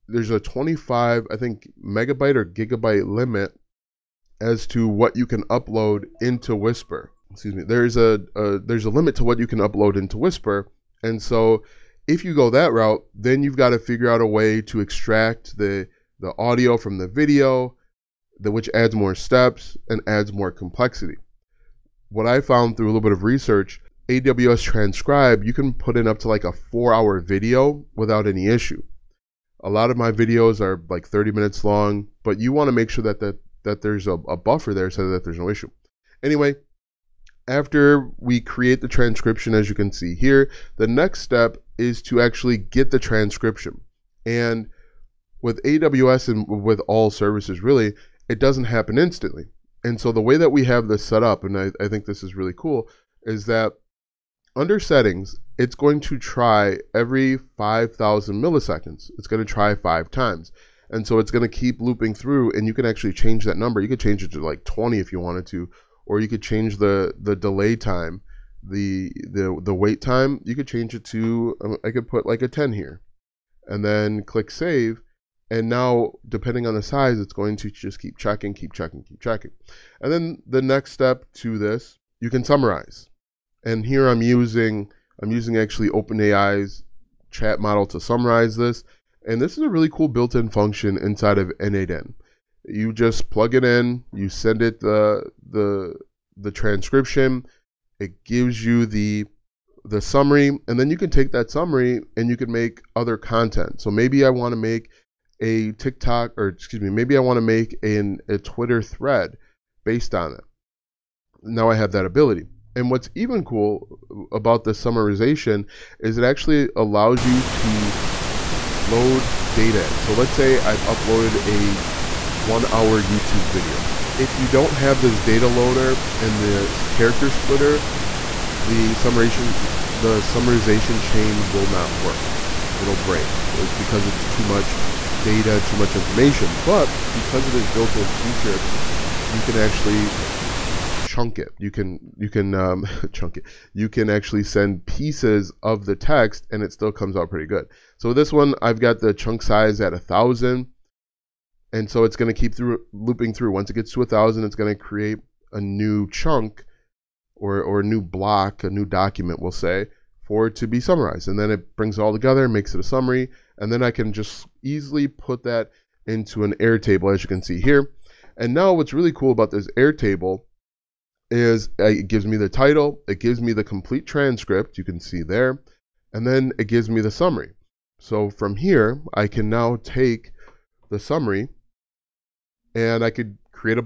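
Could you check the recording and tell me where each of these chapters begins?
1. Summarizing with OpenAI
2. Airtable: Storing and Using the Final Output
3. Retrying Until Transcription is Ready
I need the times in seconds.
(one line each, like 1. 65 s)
1. 81 s
2. 147 s
3. 58 s.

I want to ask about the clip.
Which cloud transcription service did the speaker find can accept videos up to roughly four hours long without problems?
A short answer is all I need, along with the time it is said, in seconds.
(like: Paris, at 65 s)
AWS Transcribe, at 24 s.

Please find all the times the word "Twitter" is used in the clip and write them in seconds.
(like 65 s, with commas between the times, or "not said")
108 s.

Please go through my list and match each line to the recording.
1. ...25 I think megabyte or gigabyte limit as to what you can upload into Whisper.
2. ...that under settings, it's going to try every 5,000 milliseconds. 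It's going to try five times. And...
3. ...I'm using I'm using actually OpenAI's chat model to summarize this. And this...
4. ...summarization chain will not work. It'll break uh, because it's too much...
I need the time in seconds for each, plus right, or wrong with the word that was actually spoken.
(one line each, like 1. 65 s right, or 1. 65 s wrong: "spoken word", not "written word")
1. 0 s right
2. 53 s right
3. 84 s right
4. 130 s right.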